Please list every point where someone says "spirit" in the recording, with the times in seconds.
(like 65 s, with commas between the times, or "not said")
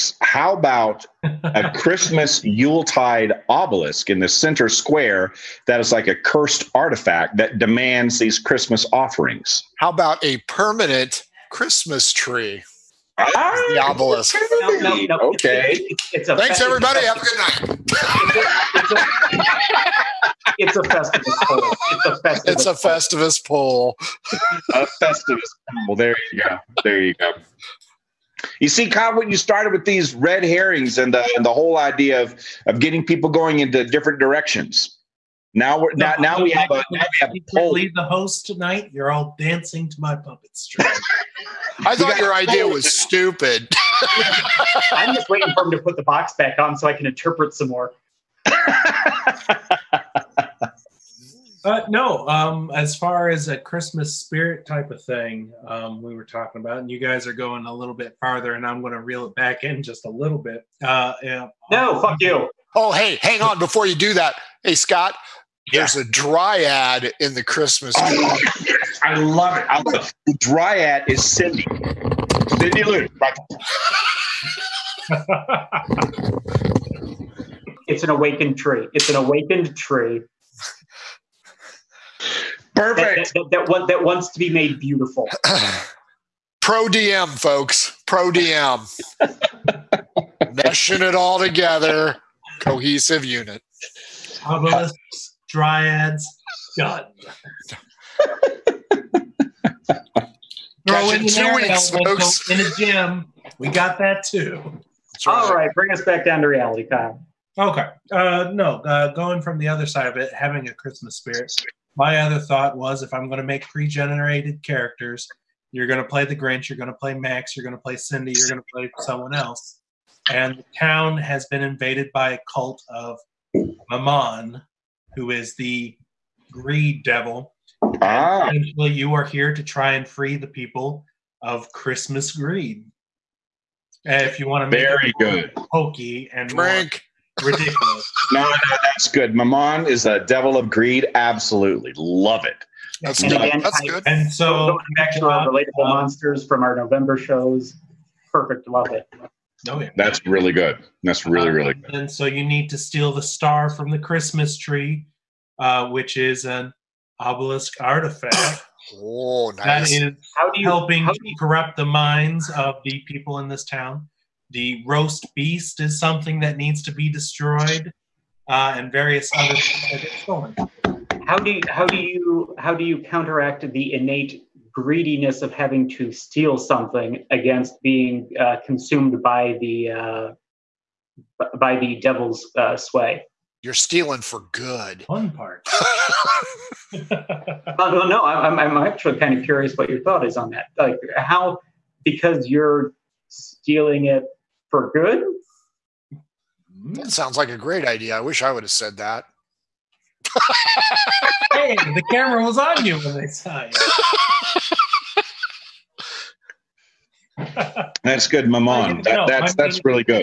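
54 s, 111 s.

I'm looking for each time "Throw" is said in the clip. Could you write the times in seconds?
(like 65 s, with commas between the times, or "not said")
100 s.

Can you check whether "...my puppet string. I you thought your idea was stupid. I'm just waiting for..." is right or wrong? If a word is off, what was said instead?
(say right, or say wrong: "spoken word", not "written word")
right.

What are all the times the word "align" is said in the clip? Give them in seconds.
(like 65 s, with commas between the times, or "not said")
not said.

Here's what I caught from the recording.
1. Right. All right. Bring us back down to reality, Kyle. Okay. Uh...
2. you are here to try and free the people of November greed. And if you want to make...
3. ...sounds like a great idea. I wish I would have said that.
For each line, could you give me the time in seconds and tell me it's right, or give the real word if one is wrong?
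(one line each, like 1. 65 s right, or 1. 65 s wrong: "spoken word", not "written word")
1. 105 s right
2. 128 s wrong: "Christmas", not "November"
3. 197 s right.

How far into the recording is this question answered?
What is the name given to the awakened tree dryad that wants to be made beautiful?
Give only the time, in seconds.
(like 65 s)
72 s.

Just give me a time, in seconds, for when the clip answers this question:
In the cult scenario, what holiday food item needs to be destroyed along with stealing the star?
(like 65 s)
164 s.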